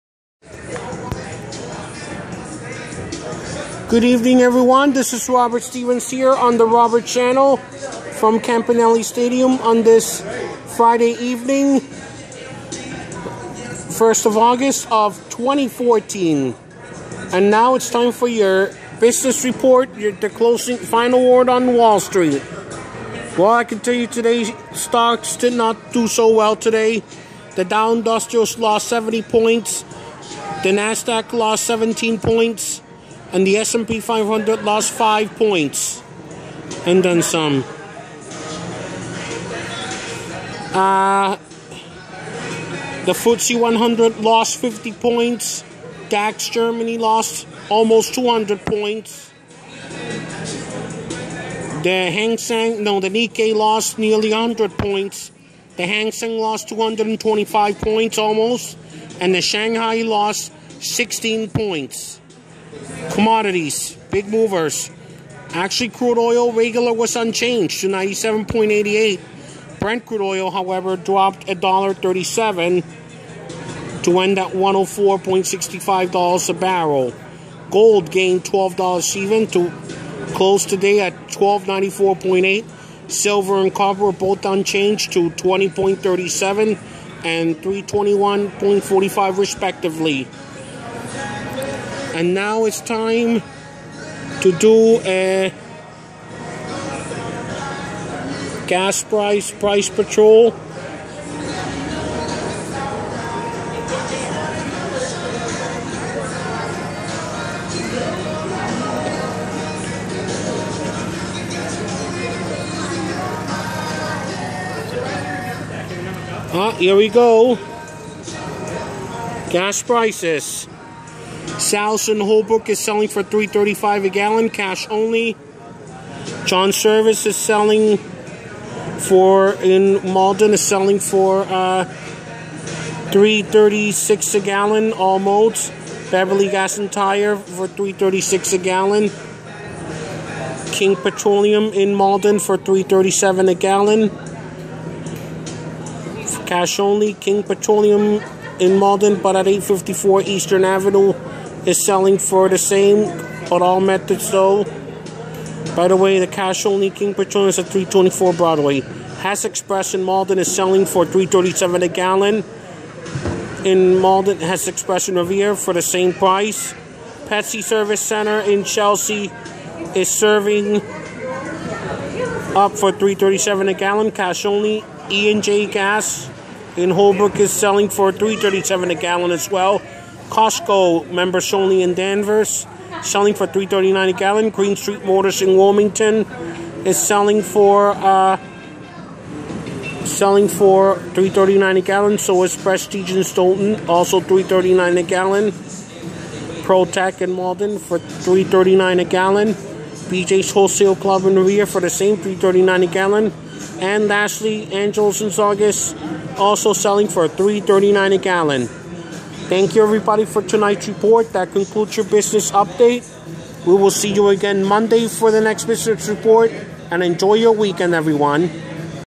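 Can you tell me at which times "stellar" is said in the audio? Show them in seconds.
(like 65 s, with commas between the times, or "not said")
not said.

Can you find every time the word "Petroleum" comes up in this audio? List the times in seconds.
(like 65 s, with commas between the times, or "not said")
140 s, 147 s, 157 s.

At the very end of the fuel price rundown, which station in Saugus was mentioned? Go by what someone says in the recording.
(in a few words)
Angels.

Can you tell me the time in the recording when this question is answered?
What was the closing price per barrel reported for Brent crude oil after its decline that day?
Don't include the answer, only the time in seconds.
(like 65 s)
74 s.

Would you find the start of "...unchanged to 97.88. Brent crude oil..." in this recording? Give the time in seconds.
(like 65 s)
67 s.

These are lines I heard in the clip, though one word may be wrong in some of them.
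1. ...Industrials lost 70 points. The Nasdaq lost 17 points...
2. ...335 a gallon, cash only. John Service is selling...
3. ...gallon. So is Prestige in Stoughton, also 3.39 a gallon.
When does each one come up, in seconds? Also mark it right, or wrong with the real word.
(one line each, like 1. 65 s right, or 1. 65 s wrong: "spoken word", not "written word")
1. 27 s right
2. 123 s right
3. 191 s right.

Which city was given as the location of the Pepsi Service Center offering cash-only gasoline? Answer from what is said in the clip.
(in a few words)
Chelsea.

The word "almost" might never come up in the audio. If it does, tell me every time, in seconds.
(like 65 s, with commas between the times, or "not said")
47 s, 58 s.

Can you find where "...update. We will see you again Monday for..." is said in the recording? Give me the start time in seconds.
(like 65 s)
212 s.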